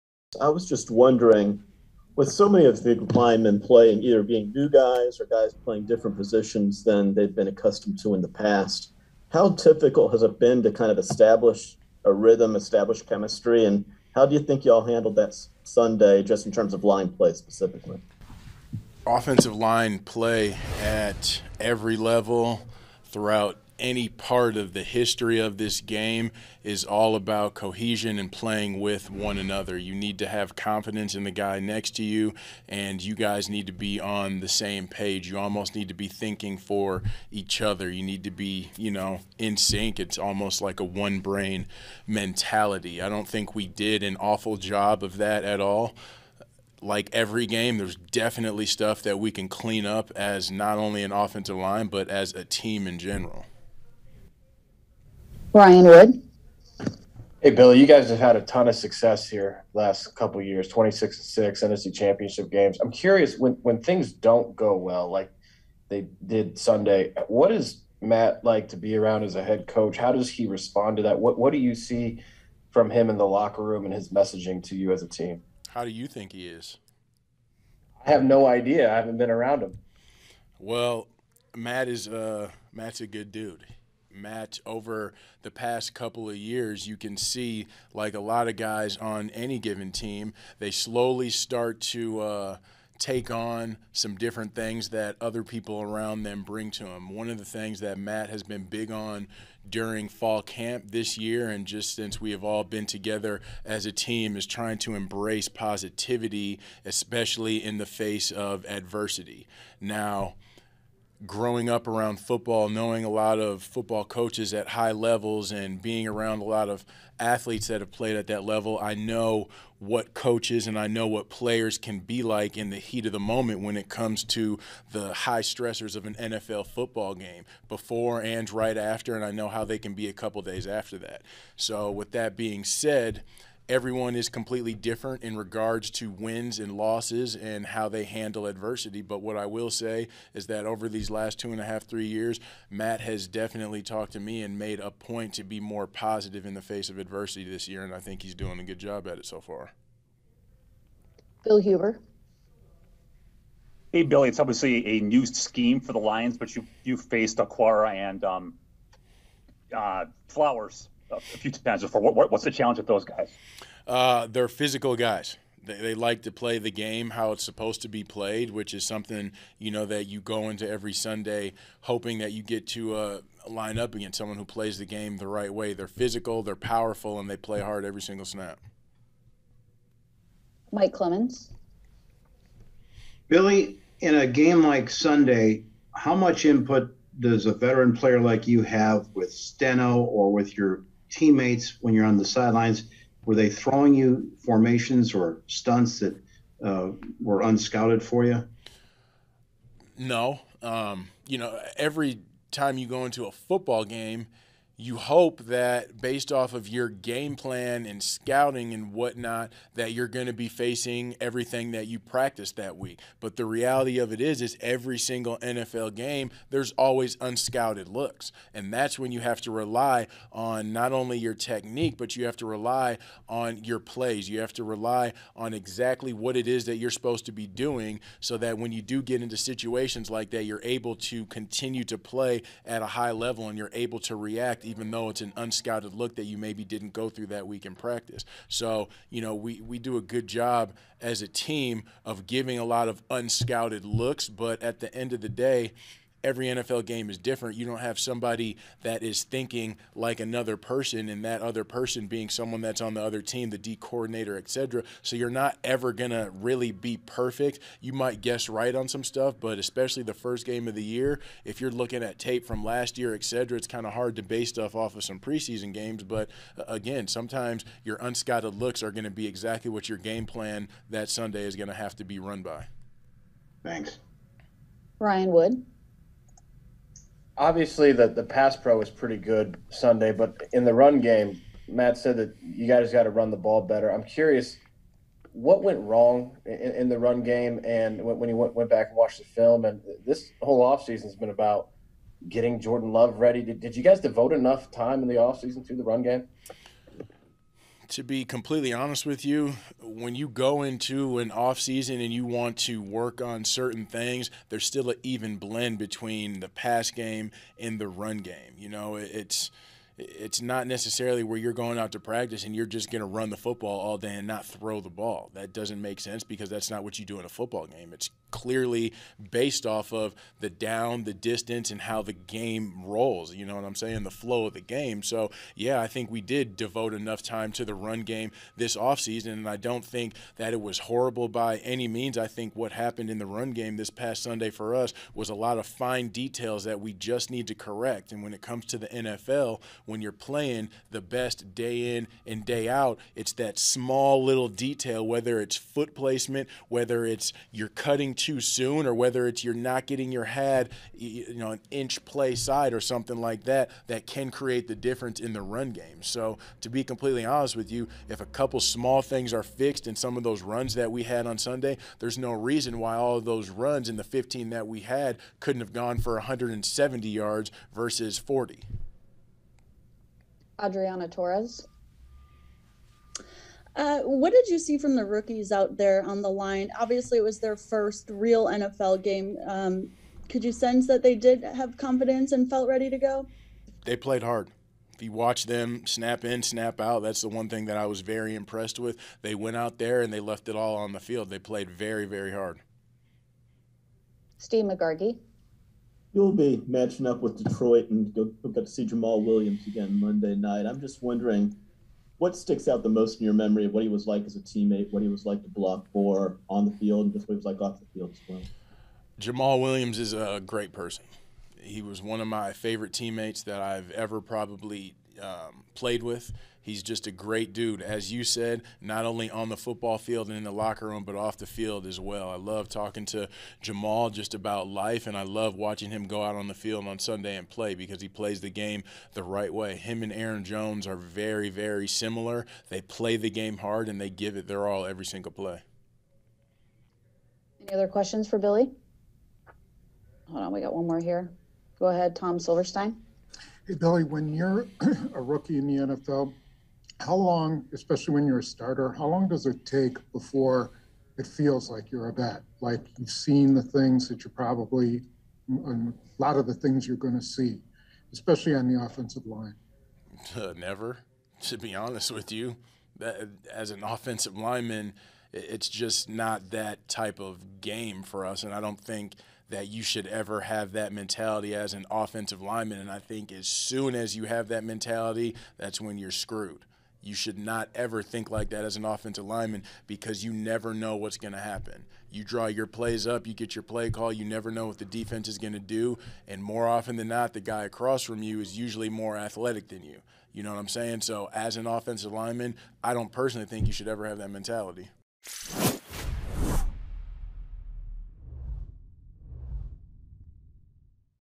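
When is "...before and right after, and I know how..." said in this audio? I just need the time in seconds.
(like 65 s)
127 s.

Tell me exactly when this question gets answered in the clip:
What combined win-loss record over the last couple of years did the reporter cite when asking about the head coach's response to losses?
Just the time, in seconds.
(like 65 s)
60 s.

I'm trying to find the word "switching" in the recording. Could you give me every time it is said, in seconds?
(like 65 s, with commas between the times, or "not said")
not said.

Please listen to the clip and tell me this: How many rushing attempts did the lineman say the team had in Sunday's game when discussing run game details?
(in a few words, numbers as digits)
15.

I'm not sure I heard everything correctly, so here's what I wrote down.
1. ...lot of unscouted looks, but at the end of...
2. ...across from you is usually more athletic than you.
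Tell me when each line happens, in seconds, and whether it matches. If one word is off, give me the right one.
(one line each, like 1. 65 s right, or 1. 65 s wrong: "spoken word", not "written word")
1. 242 s right
2. 487 s right.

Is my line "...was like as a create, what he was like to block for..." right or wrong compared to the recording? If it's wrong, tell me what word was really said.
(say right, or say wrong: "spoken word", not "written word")
wrong: "teammate", not "create".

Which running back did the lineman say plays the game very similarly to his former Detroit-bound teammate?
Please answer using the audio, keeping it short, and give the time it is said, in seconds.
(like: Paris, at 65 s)
Aaron Jones, at 430 s.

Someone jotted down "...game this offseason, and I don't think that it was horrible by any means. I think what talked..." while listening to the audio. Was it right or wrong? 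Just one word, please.
wrong.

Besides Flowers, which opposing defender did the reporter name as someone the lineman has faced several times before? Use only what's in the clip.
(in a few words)
Okwara.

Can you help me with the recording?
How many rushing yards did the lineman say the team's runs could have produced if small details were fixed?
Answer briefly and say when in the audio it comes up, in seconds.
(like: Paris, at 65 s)
170, at 366 s.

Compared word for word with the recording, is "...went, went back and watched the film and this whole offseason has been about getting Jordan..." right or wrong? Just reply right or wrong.
right.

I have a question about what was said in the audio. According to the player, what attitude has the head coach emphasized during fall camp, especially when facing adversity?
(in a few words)
positivity.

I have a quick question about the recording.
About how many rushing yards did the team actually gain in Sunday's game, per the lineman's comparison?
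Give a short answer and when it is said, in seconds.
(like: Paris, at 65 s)
40, at 368 s.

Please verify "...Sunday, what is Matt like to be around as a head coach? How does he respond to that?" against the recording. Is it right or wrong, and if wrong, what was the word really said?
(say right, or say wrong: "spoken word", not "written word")
right.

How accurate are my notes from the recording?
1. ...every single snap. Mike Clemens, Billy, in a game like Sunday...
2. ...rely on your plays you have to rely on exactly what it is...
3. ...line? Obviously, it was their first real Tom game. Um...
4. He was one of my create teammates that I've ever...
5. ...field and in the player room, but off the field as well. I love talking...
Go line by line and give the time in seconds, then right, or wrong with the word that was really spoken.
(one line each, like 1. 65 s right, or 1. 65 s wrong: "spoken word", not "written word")
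1. 177 s right
2. 222 s right
3. 376 s wrong: "NFL", not "Tom"
4. 411 s wrong: "favorite", not "create"
5. 419 s wrong: "locker", not "player".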